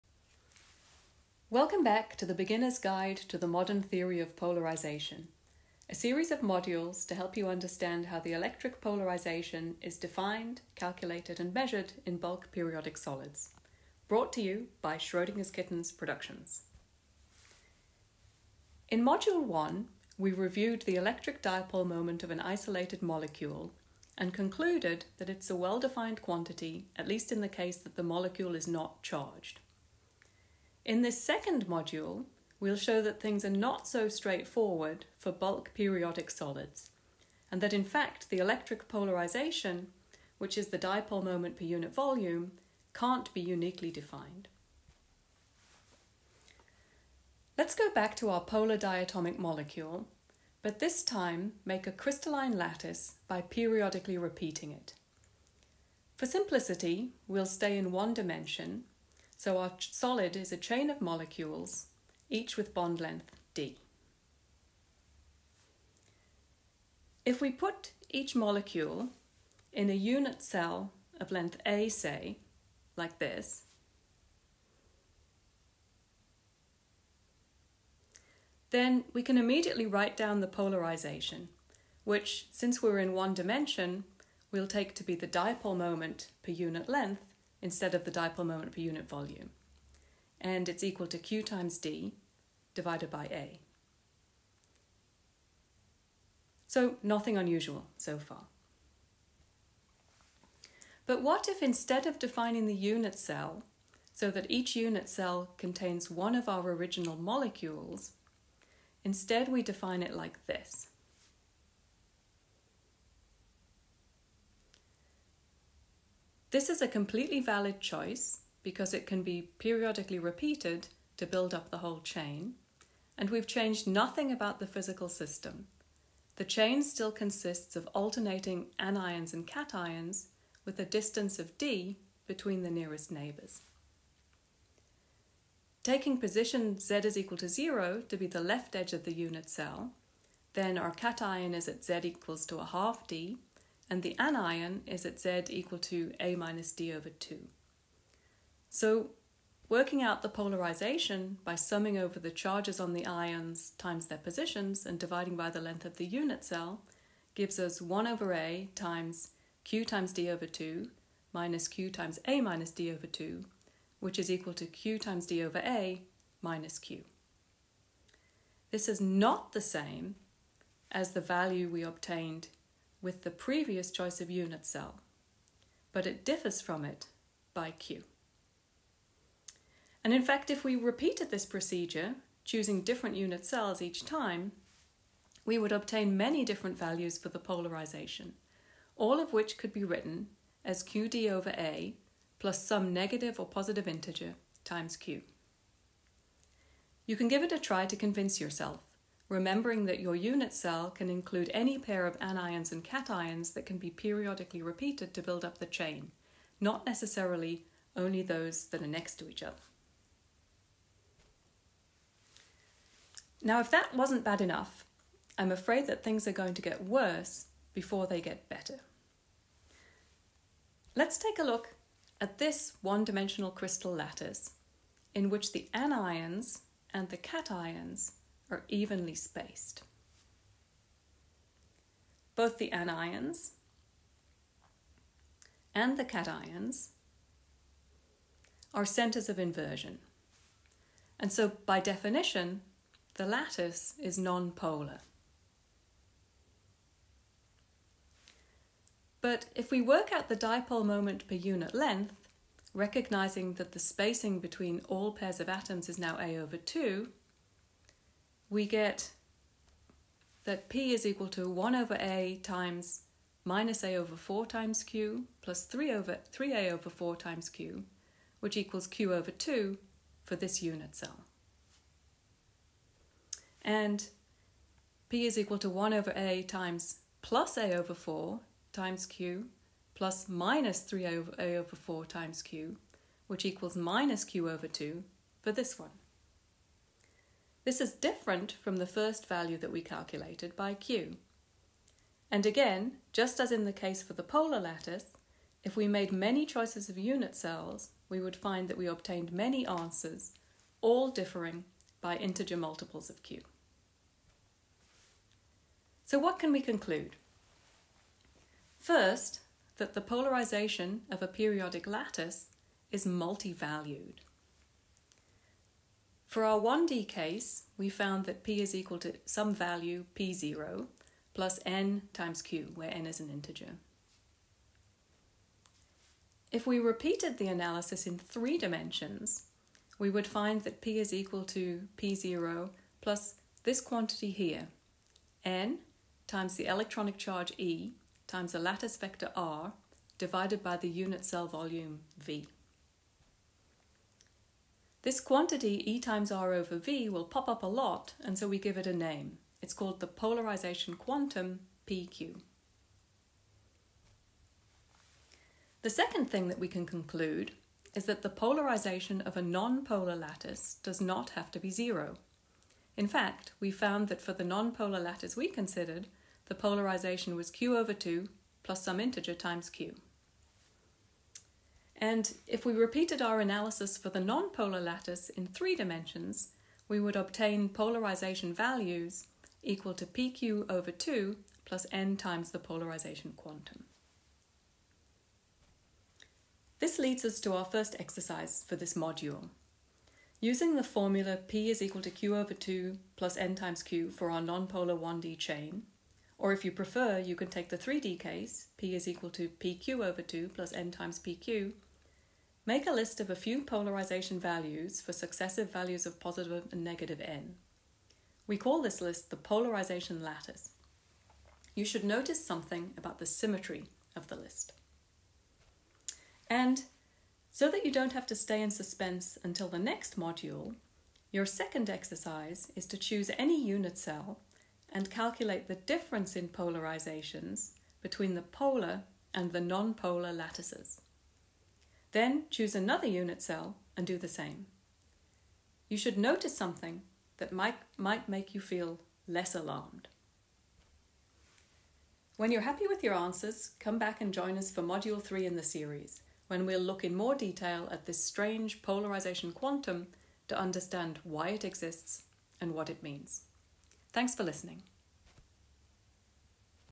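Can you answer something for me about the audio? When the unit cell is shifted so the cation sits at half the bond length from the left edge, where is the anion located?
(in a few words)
A - D/2.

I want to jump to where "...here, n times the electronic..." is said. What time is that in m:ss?
5:34.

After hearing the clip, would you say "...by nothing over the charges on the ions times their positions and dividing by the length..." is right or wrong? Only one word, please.
wrong.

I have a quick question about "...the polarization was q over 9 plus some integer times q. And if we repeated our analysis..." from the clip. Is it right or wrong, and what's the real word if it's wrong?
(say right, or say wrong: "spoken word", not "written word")
wrong: "2", not "9".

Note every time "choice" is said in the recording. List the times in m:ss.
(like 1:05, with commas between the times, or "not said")
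1:57, 2:53, 4:56.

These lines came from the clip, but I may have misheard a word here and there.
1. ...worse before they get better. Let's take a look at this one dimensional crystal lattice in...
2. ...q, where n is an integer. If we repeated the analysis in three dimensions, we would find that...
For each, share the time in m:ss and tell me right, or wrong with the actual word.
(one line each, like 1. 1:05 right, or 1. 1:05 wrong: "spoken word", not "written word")
1. 3:36 right
2. 5:22 right.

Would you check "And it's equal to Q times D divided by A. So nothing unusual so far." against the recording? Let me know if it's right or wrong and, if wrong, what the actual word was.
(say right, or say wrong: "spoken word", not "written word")
right.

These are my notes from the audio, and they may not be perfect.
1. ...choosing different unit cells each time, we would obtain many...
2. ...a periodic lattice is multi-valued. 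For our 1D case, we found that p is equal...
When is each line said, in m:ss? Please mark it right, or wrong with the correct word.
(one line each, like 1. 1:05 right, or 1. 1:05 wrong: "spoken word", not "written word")
1. 3:02 right
2. 5:11 right.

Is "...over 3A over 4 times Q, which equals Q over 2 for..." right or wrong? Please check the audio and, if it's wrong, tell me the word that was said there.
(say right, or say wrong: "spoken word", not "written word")
right.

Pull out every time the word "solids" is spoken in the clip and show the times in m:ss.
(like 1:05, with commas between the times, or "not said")
0:12, 0:36, 0:59.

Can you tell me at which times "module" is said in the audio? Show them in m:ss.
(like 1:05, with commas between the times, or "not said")
0:06, 0:19, 0:31, 6:28, 7:00, 7:24.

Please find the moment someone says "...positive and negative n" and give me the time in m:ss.
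6:46.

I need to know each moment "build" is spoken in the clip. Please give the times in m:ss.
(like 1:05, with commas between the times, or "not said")
2:01, 3:25.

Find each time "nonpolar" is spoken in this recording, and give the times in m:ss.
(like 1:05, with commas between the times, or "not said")
4:04, 6:14, 6:34, 7:09.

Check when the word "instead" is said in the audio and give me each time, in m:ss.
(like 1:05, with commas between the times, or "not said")
1:27, 1:41, 1:49.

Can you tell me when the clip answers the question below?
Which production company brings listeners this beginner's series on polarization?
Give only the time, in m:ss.
0:14.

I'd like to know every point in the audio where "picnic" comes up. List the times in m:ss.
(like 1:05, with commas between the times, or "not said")
not said.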